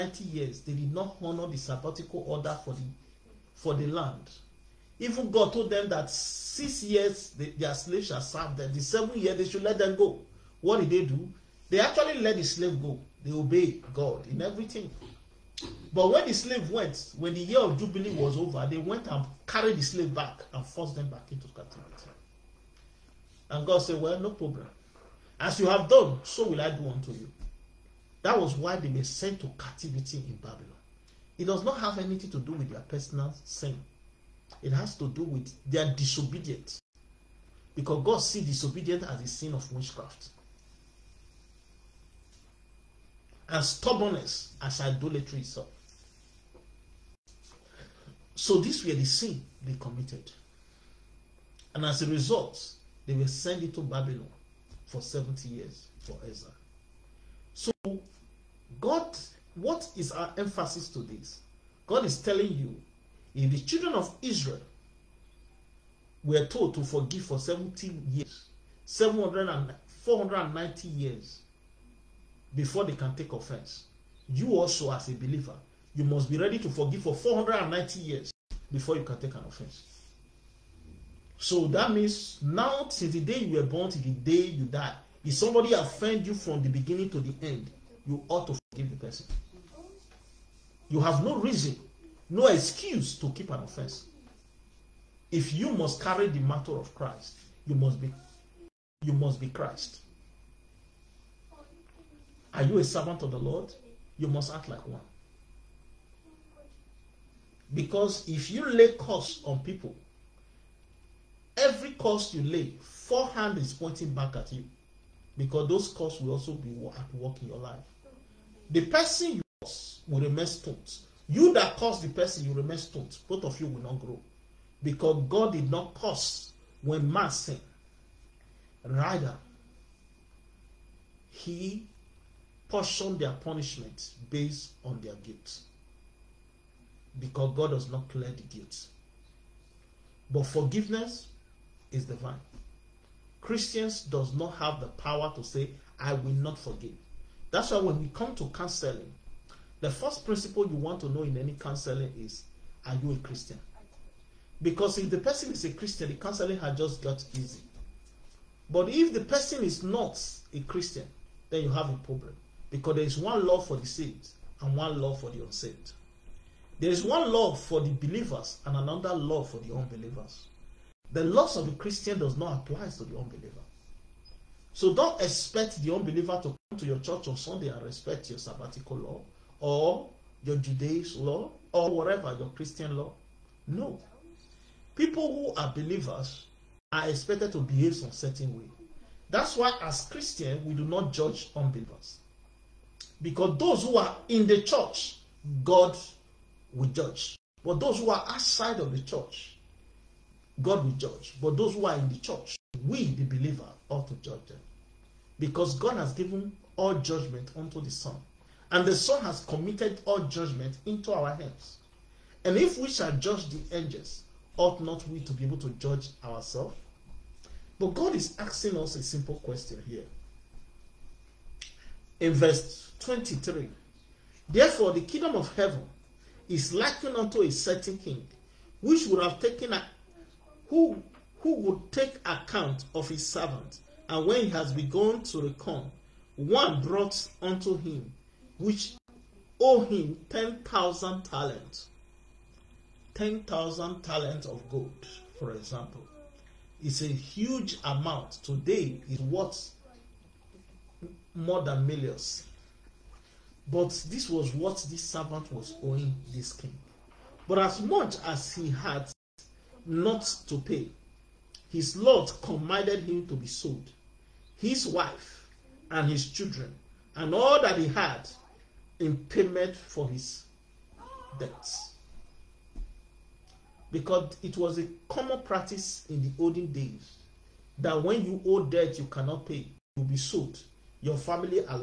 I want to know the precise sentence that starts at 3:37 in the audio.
But God is asking us a simple question here.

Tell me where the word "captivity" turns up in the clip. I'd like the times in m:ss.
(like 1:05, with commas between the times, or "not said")
0:21, 0:29.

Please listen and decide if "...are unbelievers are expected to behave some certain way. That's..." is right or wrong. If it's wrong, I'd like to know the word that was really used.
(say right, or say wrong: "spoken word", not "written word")
wrong: "believers", not "unbelievers".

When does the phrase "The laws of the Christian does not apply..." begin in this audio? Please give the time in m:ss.
2:51.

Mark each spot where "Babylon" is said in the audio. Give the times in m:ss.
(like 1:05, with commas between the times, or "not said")
0:30, 0:53.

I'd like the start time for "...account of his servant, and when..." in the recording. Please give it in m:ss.
3:52.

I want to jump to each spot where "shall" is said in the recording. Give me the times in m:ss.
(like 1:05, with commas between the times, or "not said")
0:08, 3:32.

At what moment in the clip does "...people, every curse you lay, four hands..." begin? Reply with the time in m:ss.
1:49.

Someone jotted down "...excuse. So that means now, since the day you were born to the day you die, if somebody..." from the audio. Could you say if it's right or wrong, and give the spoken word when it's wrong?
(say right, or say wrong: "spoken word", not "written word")
wrong: "offense", not "excuse".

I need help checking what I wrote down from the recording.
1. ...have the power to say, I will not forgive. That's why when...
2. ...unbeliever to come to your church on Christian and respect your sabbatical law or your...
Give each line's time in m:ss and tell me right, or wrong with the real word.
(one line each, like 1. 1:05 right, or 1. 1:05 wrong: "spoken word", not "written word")
1. 2:24 right
2. 2:55 wrong: "Sunday", not "Christian".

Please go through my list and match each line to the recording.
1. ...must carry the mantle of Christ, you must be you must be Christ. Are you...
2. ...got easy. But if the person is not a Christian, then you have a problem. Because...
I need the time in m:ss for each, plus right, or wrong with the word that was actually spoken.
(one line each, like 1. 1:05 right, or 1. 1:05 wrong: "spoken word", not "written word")
1. 1:35 right
2. 2:37 right.